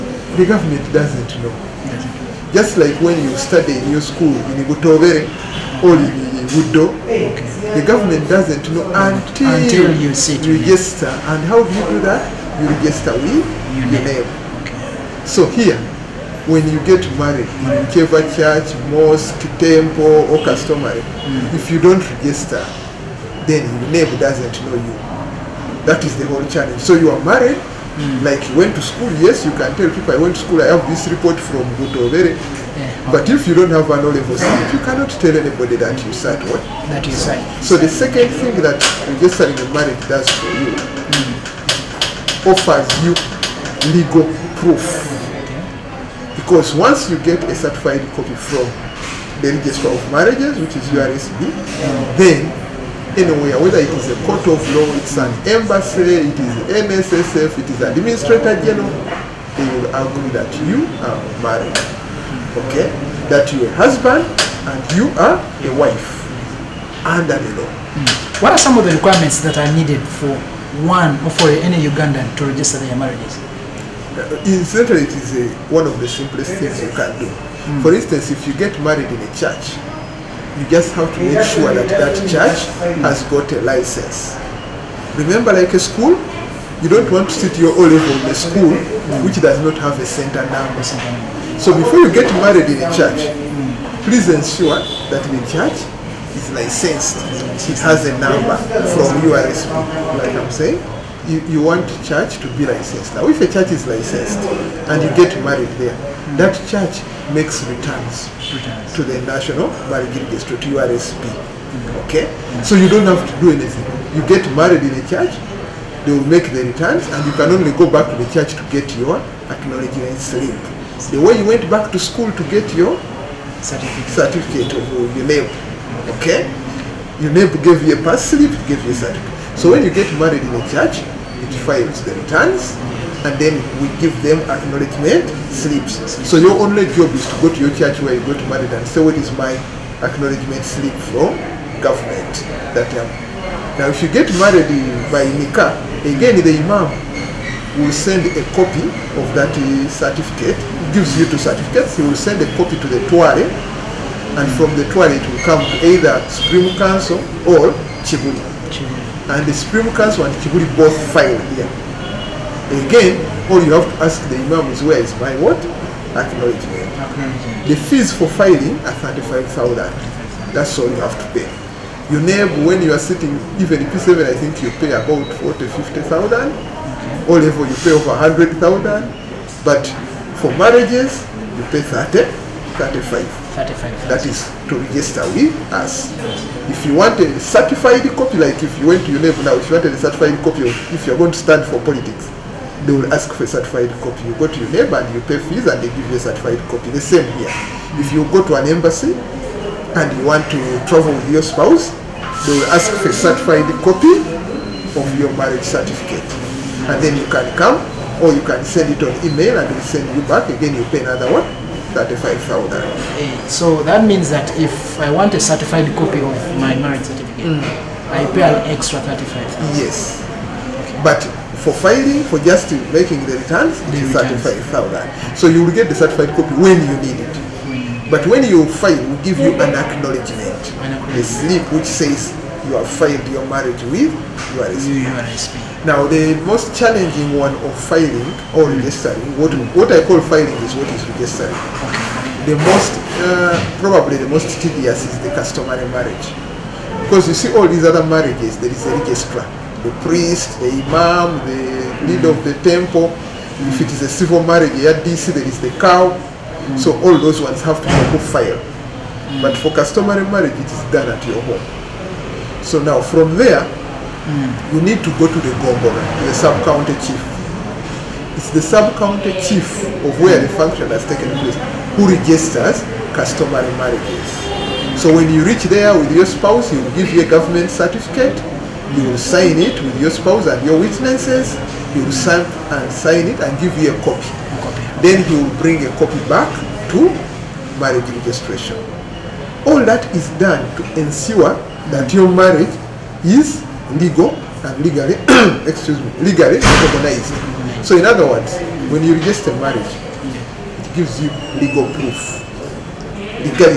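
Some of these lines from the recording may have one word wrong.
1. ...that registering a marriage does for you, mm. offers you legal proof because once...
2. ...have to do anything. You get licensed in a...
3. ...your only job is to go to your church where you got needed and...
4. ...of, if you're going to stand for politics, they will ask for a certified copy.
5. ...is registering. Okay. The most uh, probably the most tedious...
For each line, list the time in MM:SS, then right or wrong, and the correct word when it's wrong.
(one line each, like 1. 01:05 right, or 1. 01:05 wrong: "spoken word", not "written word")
1. 00:38 right
2. 01:53 wrong: "married", not "licensed"
3. 02:16 wrong: "married", not "needed"
4. 03:10 right
5. 04:00 right.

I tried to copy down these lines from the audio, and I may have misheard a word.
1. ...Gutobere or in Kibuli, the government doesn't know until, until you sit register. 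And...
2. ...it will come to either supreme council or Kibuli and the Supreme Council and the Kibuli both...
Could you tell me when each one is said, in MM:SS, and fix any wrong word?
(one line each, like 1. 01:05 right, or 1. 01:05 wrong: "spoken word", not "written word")
1. 00:04 wrong: "Gudo", not "Kibuli"
2. 02:35 right.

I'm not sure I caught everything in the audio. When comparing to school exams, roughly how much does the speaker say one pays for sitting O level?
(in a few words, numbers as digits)
over 100,000.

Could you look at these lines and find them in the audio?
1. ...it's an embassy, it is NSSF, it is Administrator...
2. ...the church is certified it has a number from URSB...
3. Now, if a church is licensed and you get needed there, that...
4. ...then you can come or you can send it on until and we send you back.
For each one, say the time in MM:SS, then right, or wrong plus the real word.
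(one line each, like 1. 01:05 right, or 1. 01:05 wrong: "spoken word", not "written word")
1. 00:54 right
2. 01:35 wrong: "licensed", not "certified"
3. 01:43 wrong: "married", not "needed"
4. 03:27 wrong: "email", not "until".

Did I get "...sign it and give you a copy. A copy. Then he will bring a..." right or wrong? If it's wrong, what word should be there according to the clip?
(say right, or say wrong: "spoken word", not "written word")
right.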